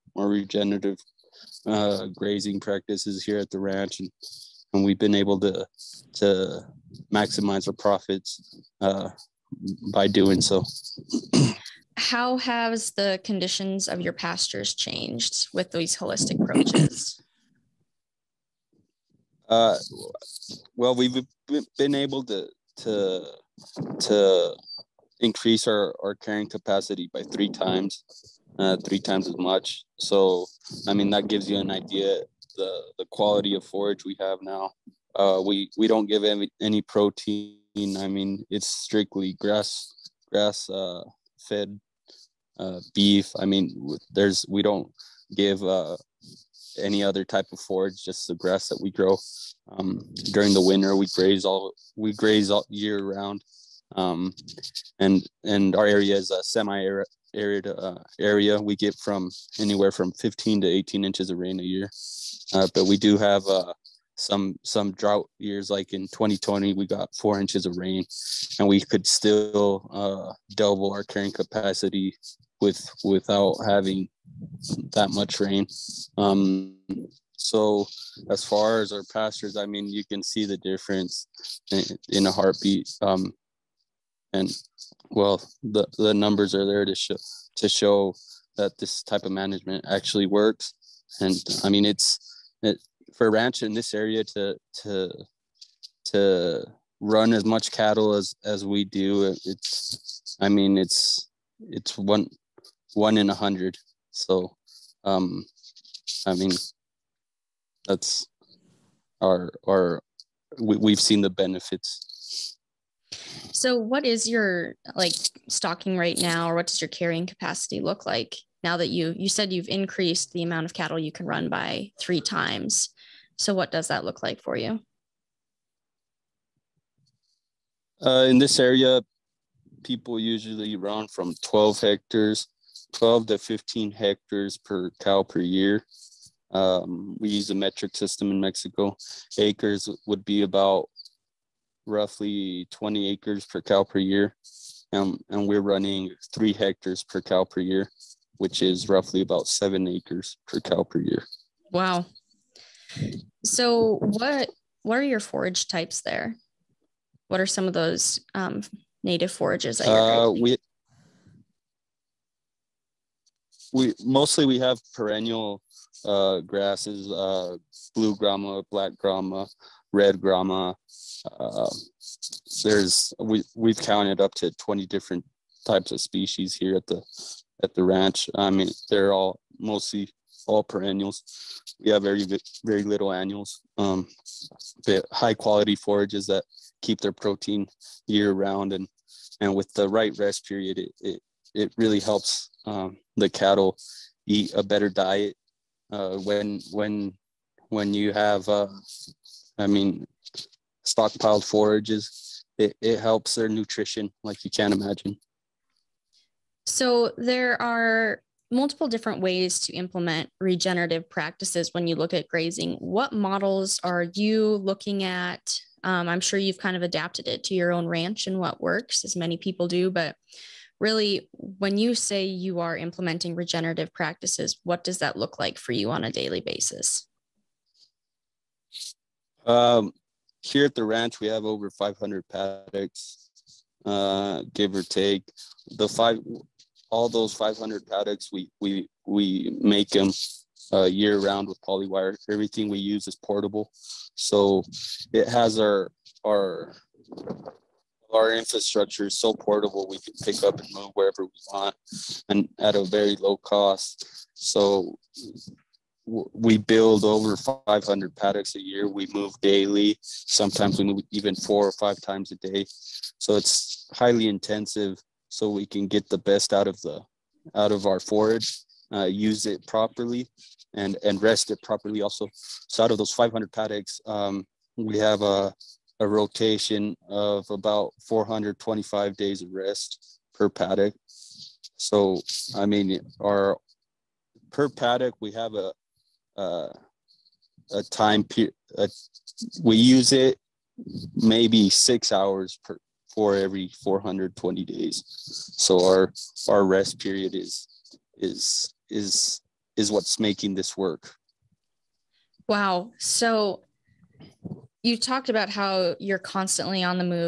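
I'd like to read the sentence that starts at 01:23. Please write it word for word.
Um, and well, the the numbers are there to show to show that this type of management actually works.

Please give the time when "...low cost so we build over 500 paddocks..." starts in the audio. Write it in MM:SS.
04:13.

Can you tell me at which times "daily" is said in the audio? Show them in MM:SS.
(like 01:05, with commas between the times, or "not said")
03:46, 04:19.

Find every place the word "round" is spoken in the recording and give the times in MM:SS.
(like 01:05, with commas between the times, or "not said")
00:53, 03:08, 04:01.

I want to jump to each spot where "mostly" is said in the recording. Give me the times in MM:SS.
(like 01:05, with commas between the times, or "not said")
02:44, 02:59.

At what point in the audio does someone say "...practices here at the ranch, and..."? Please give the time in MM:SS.
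00:02.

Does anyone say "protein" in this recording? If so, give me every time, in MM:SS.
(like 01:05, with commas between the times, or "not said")
00:36, 03:07.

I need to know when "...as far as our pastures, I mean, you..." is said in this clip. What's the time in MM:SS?
01:18.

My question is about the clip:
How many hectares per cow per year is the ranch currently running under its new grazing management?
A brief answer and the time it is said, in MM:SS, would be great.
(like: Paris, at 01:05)
3 hectares, at 02:26.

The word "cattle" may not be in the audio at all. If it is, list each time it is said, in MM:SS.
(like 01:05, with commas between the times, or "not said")
01:37, 02:00, 03:13.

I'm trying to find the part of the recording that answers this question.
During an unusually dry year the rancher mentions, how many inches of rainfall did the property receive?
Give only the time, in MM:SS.
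01:07.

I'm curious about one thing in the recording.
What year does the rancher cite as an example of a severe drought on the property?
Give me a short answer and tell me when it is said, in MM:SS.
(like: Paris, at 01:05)
2020, at 01:06.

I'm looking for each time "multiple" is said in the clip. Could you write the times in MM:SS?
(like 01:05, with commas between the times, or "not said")
03:28.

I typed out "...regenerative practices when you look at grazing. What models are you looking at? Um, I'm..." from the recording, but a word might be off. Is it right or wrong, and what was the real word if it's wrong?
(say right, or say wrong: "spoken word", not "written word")
right.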